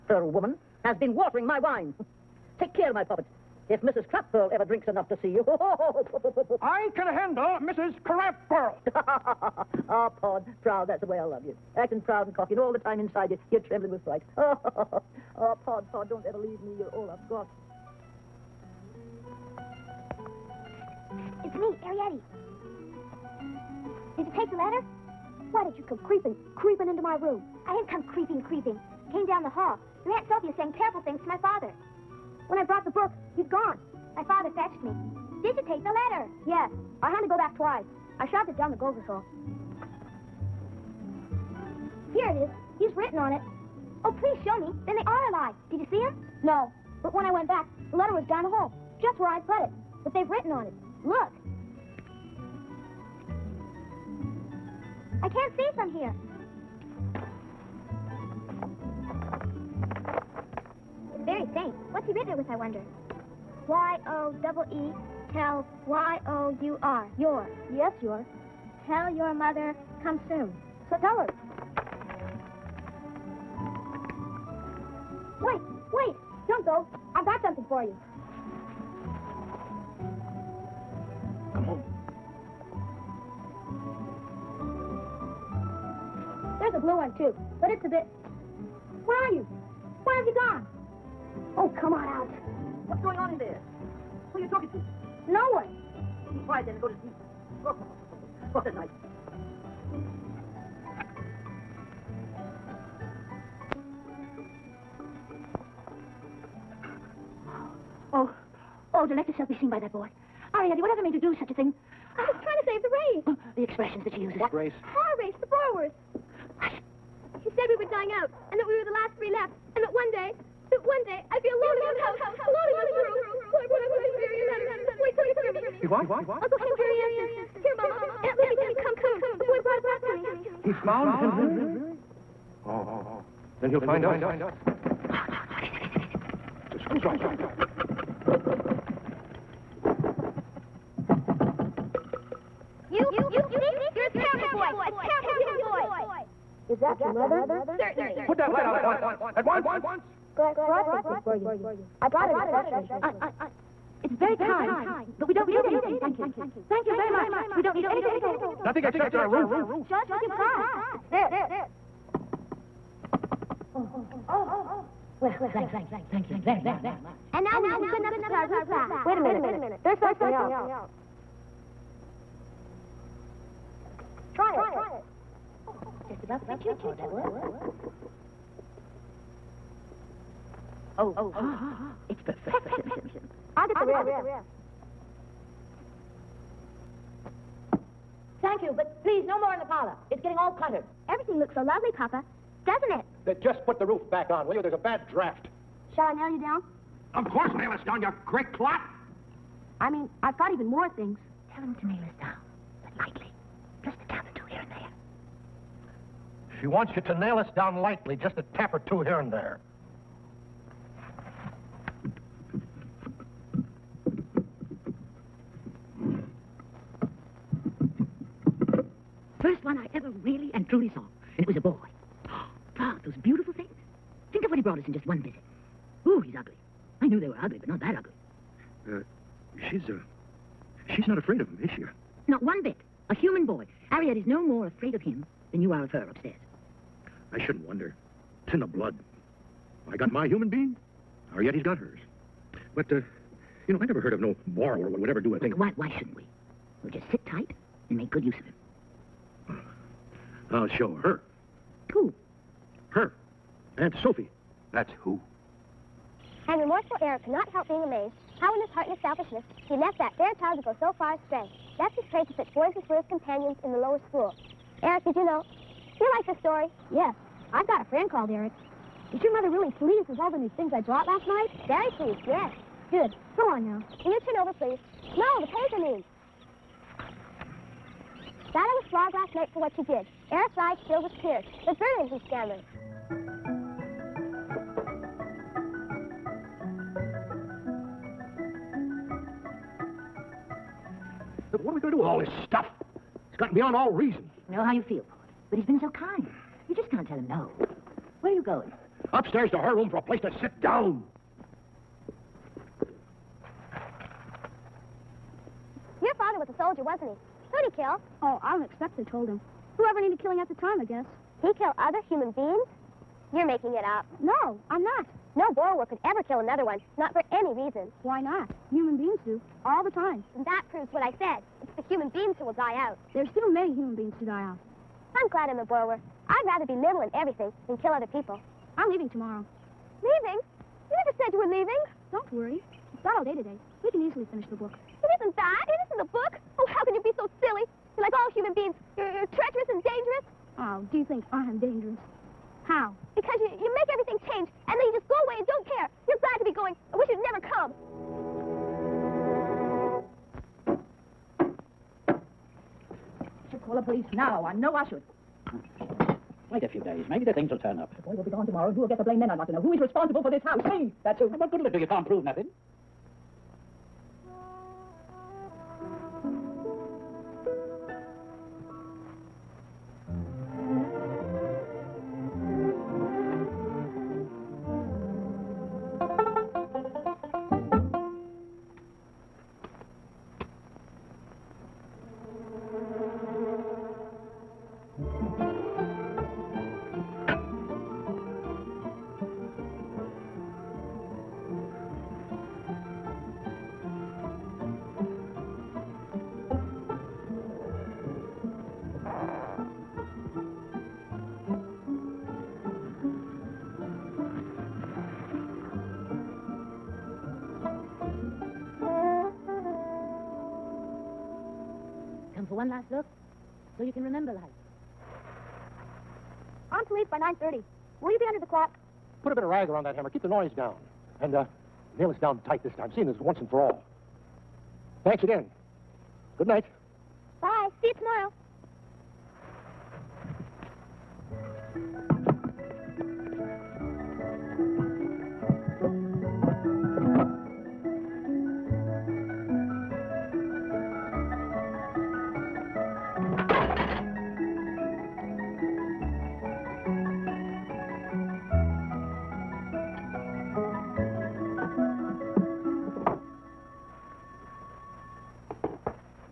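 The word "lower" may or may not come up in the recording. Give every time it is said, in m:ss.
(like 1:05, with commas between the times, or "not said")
4:23.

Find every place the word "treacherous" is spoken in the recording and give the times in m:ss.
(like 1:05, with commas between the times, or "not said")
5:39.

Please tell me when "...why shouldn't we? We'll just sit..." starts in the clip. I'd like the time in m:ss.
4:05.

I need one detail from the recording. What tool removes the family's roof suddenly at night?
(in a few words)
A screwdriver.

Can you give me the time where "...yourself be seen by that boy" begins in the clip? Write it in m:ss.
1:49.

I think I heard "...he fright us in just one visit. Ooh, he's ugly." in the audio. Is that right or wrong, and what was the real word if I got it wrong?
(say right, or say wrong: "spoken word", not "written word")
wrong: "brought", not "fright".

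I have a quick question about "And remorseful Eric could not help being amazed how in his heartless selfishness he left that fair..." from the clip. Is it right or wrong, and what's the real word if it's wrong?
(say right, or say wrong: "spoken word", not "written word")
right.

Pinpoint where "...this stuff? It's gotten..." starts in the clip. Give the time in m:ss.
4:52.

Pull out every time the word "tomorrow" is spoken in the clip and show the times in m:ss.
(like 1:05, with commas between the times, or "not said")
5:29, 5:58.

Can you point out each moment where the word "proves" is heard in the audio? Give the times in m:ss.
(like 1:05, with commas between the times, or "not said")
5:20, 6:02.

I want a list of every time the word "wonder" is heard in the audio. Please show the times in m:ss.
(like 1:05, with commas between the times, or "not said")
1:02, 3:57.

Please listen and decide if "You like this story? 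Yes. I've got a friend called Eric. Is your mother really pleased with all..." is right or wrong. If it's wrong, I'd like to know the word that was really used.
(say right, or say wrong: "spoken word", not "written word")
right.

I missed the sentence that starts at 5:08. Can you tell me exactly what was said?
Oh, I don't expect they told him.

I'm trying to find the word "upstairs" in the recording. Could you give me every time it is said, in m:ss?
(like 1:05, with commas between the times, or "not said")
3:56, 4:59.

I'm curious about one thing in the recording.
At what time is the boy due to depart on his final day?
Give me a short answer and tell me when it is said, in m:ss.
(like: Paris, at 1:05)
9:30, at 6:57.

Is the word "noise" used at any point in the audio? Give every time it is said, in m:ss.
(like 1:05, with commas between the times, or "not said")
7:00.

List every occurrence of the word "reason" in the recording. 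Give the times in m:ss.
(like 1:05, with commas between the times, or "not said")
4:53, 5:17.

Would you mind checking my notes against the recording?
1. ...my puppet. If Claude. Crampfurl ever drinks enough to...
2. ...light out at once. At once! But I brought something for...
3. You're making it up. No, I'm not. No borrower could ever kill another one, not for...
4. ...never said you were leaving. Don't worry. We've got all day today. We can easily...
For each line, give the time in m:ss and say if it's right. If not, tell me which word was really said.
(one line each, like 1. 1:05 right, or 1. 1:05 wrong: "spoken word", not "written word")
1. 0:02 wrong: "Mrs", not "Claude"
2. 2:28 right
3. 5:13 right
4. 5:31 right.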